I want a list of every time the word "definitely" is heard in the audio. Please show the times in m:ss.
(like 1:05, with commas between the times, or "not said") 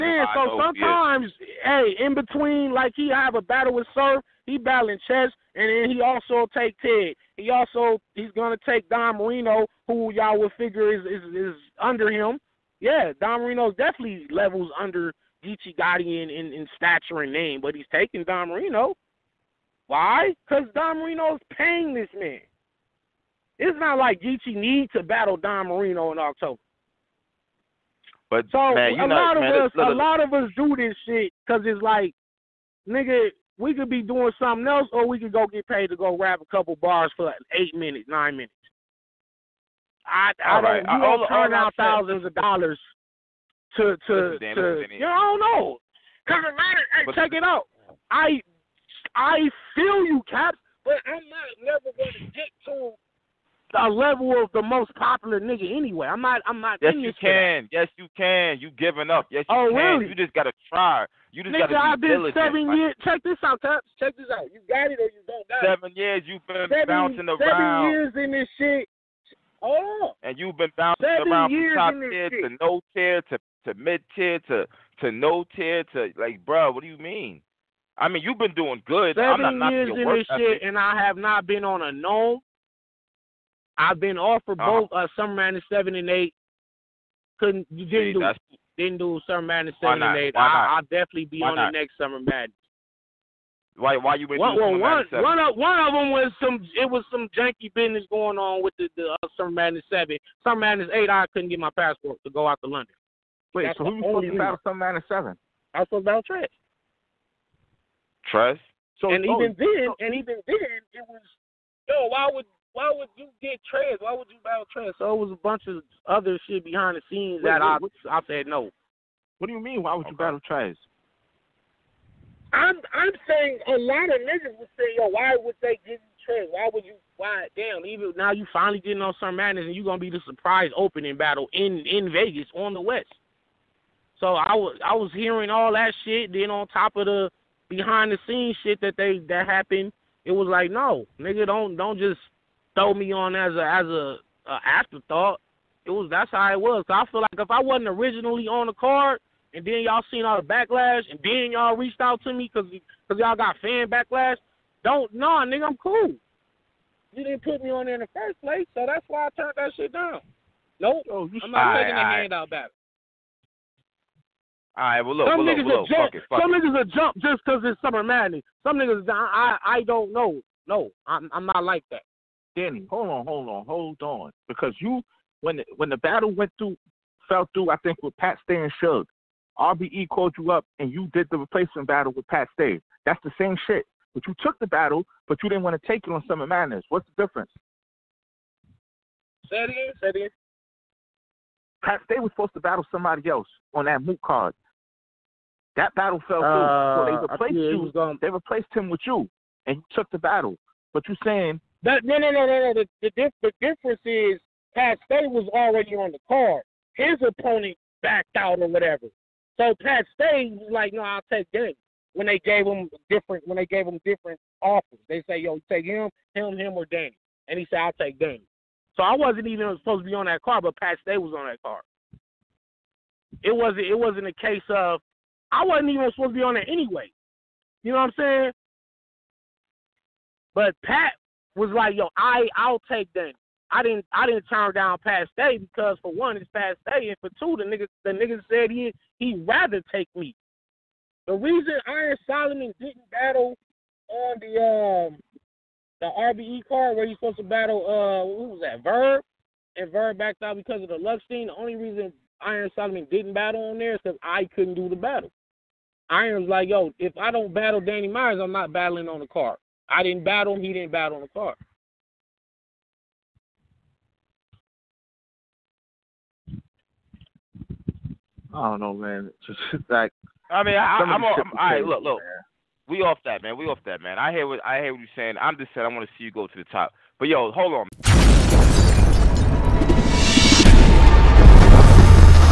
0:13, 1:30.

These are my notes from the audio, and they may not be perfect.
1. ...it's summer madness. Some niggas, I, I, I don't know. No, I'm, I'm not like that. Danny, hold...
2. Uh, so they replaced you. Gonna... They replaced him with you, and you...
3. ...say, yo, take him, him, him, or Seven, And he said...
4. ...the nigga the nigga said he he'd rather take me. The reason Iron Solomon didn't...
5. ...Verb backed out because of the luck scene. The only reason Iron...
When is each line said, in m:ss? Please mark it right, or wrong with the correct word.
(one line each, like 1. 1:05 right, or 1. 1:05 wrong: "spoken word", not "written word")
1. 2:47 right
2. 3:16 right
3. 3:35 wrong: "Danny", not "Seven"
4. 3:57 right
5. 4:09 right.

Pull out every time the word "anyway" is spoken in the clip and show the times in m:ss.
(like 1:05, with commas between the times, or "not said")
0:55, 3:46.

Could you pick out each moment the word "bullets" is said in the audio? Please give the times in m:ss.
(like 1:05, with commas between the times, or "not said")
not said.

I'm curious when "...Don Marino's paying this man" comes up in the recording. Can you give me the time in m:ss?
0:20.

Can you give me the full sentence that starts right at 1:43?
Wait, That's so who was supposed to battle Summer Madness seven?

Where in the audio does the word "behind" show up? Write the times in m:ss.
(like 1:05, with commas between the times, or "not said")
1:56, 2:17.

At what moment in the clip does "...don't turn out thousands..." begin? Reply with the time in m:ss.
0:40.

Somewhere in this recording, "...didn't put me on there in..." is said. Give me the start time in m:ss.
2:37.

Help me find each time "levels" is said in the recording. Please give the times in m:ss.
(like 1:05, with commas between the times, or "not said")
0:14, 0:53.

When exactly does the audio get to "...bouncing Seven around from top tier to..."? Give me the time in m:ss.
1:10.